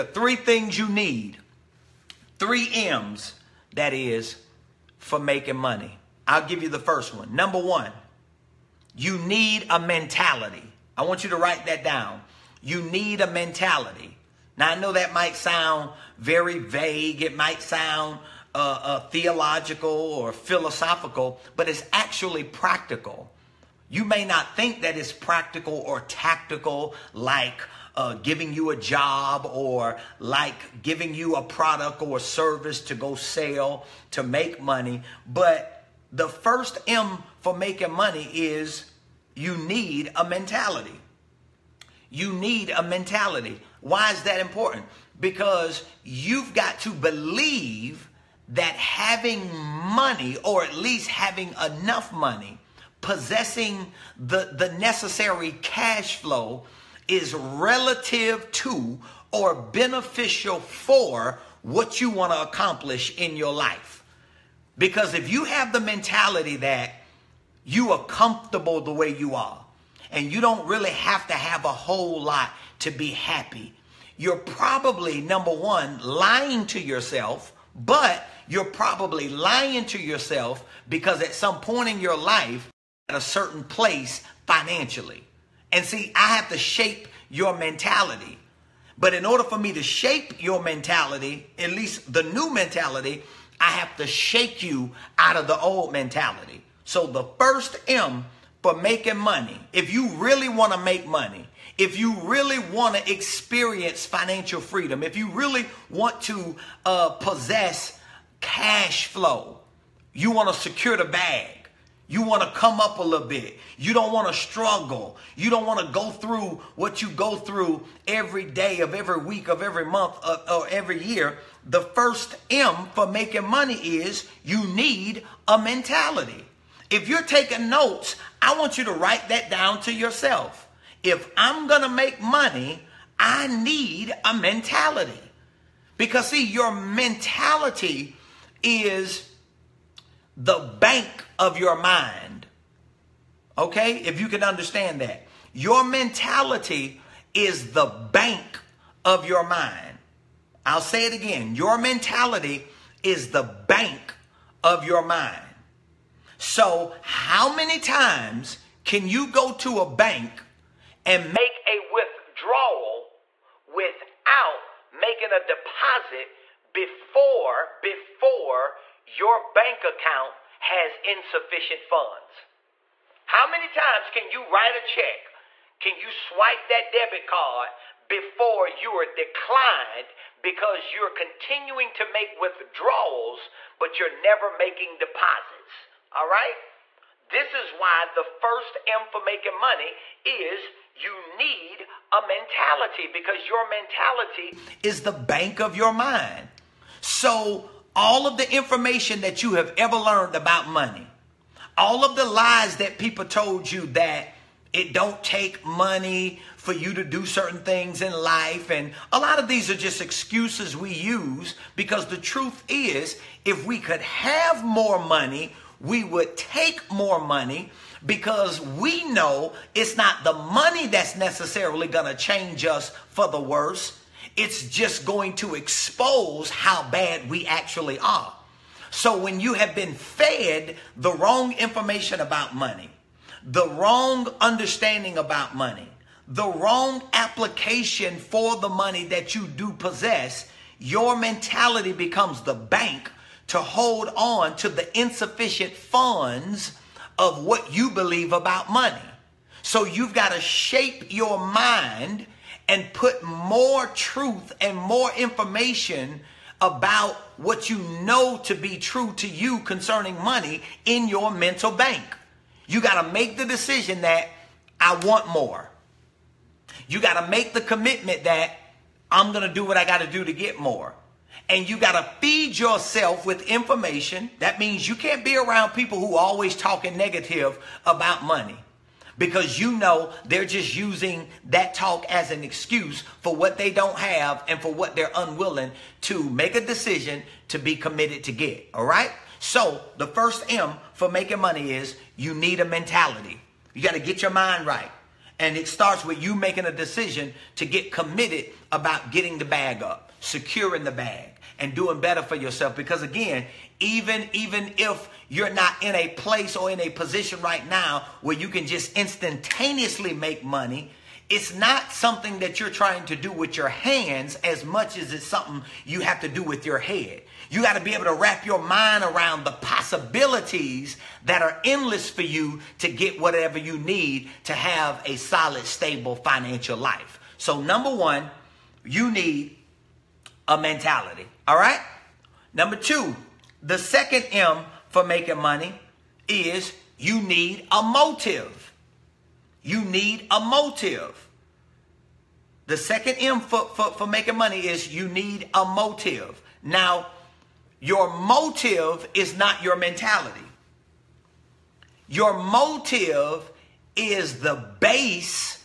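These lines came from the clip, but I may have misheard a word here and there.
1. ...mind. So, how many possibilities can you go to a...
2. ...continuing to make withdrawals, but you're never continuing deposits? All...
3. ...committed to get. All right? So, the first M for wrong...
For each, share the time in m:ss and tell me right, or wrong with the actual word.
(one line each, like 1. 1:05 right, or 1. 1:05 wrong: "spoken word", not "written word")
1. 2:35 wrong: "times", not "possibilities"
2. 3:01 wrong: "making", not "continuing"
3. 4:47 wrong: "making", not "wrong".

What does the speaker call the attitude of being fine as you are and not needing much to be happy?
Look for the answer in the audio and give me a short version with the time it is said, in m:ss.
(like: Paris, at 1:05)
Comfortable, at 1:08.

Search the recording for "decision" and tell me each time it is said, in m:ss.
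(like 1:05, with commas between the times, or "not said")
4:23, 4:46, 4:56.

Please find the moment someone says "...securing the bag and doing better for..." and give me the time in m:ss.
5:00.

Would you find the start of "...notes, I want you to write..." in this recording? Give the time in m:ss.
2:07.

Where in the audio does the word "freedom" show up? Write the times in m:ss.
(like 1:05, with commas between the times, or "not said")
1:44.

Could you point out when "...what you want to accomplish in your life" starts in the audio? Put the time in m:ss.
1:01.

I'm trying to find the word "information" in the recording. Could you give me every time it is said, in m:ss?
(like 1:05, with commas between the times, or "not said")
3:18, 3:51, 4:15, 4:33.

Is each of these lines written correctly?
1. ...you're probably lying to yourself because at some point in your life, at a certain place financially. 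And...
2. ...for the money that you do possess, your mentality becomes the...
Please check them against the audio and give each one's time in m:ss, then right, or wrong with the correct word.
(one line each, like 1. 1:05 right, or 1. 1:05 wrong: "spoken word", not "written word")
1. 1:18 right
2. 3:58 right.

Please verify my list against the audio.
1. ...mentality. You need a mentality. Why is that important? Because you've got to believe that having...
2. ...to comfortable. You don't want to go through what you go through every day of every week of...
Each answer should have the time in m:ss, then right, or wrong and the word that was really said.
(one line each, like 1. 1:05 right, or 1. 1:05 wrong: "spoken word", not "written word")
1. 0:40 right
2. 1:54 wrong: "struggle", not "comfortable".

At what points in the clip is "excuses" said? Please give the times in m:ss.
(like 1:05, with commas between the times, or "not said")
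3:30, 4:42.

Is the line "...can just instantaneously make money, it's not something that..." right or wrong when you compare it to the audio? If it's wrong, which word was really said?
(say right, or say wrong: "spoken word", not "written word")
right.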